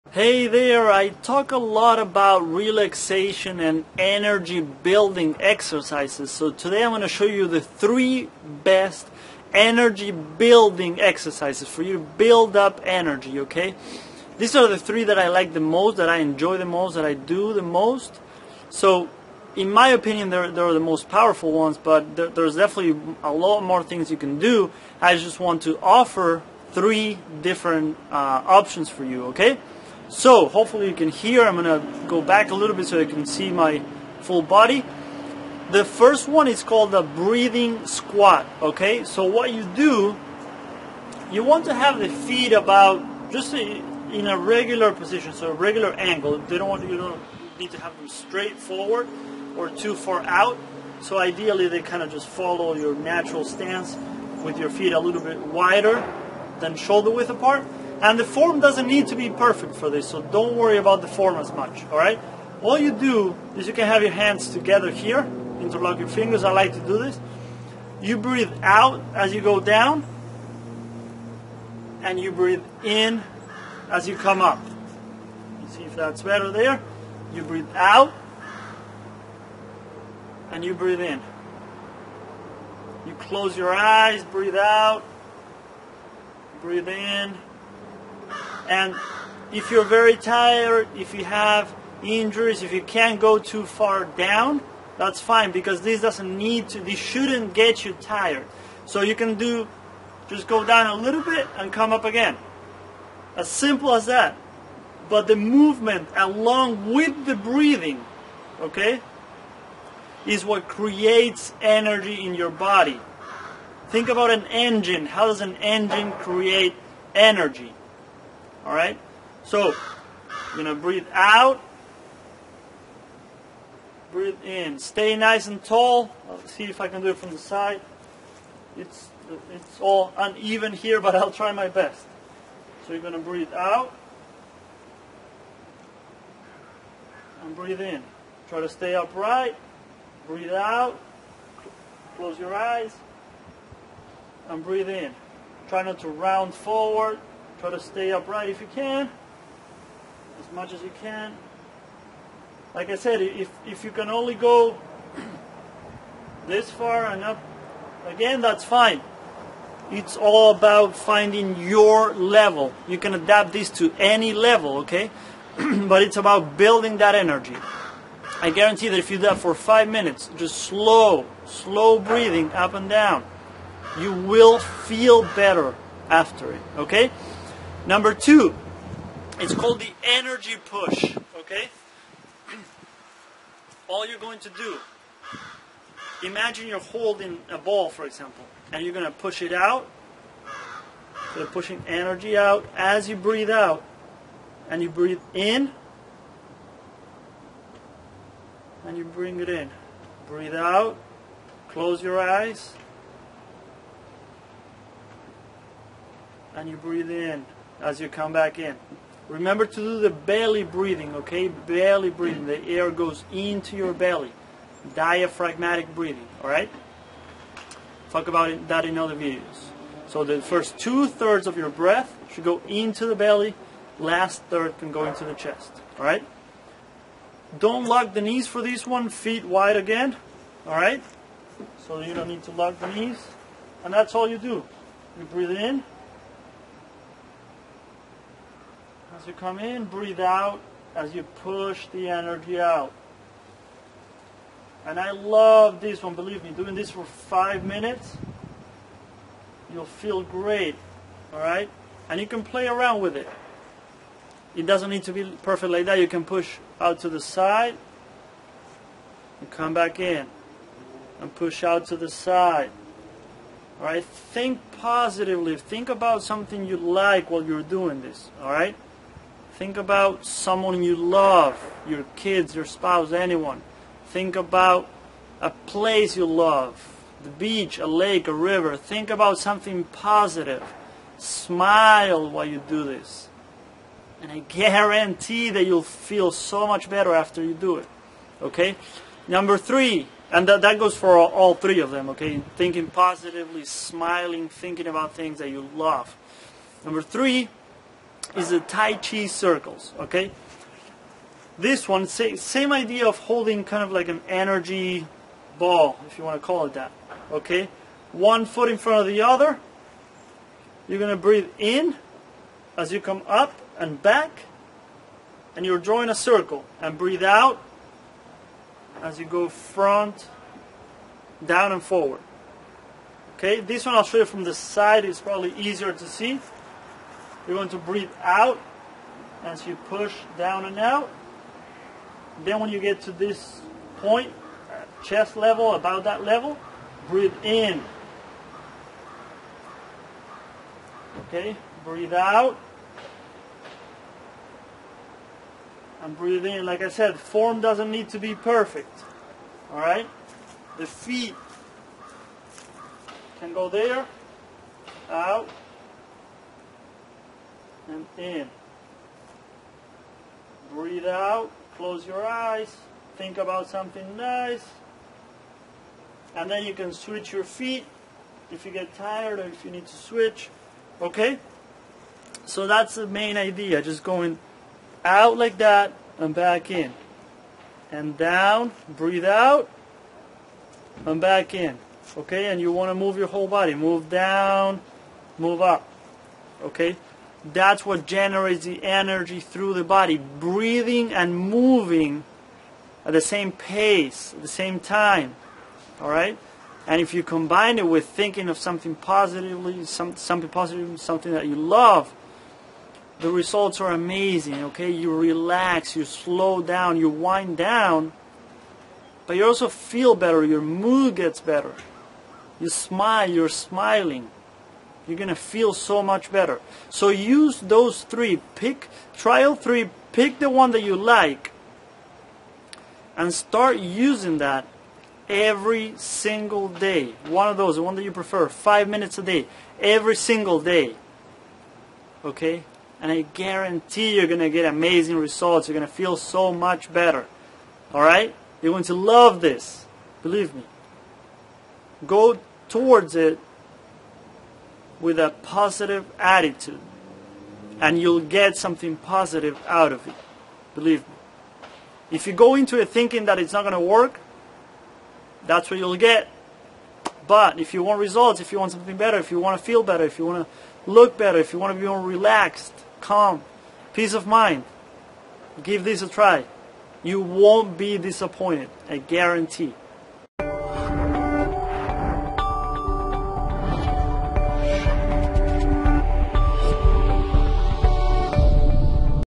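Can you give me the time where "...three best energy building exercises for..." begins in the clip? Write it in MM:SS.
00:07.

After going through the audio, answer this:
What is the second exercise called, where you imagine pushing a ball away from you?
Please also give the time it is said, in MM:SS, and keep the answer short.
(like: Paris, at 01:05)
Energy push, at 03:00.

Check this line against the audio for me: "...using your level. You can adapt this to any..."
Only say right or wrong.
wrong.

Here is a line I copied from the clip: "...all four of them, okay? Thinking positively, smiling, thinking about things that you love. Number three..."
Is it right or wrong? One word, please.
wrong.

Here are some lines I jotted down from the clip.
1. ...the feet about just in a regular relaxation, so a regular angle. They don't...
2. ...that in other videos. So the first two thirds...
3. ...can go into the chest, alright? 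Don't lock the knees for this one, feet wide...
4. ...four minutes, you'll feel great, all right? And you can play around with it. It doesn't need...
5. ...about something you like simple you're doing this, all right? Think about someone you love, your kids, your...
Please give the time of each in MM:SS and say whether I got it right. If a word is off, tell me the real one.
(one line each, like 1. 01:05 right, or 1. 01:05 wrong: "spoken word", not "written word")
1. 00:41 wrong: "position", not "relaxation"
2. 03:38 right
3. 03:44 right
4. 04:07 wrong: "five", not "four"
5. 04:25 wrong: "while", not "simple".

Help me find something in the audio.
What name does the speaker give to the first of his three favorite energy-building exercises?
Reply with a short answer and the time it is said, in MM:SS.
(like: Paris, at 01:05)
Breathing squat, at 00:37.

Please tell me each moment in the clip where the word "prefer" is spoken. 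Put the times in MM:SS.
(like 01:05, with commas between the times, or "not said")
07:08.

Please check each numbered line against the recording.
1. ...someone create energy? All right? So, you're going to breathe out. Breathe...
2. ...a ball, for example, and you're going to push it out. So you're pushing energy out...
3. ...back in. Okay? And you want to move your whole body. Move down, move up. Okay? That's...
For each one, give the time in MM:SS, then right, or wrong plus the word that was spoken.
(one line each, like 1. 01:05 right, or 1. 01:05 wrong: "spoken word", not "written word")
1. 01:55 wrong: "engine", not "someone"
2. 03:07 right
3. 06:21 right.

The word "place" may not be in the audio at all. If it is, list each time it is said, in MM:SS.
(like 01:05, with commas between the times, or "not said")
04:35.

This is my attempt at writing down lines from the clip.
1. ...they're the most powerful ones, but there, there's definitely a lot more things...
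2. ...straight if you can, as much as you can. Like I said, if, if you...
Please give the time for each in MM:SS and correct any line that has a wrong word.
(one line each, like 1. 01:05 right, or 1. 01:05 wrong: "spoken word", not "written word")
1. 00:20 right
2. 02:28 wrong: "upright", not "straight".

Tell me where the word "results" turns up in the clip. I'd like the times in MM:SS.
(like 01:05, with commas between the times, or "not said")
06:43, 07:15, 07:37.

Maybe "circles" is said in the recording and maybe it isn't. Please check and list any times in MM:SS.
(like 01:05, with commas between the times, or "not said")
04:59, 05:16.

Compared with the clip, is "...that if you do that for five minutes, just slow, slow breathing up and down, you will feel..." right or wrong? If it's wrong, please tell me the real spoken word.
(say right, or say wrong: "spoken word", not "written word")
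right.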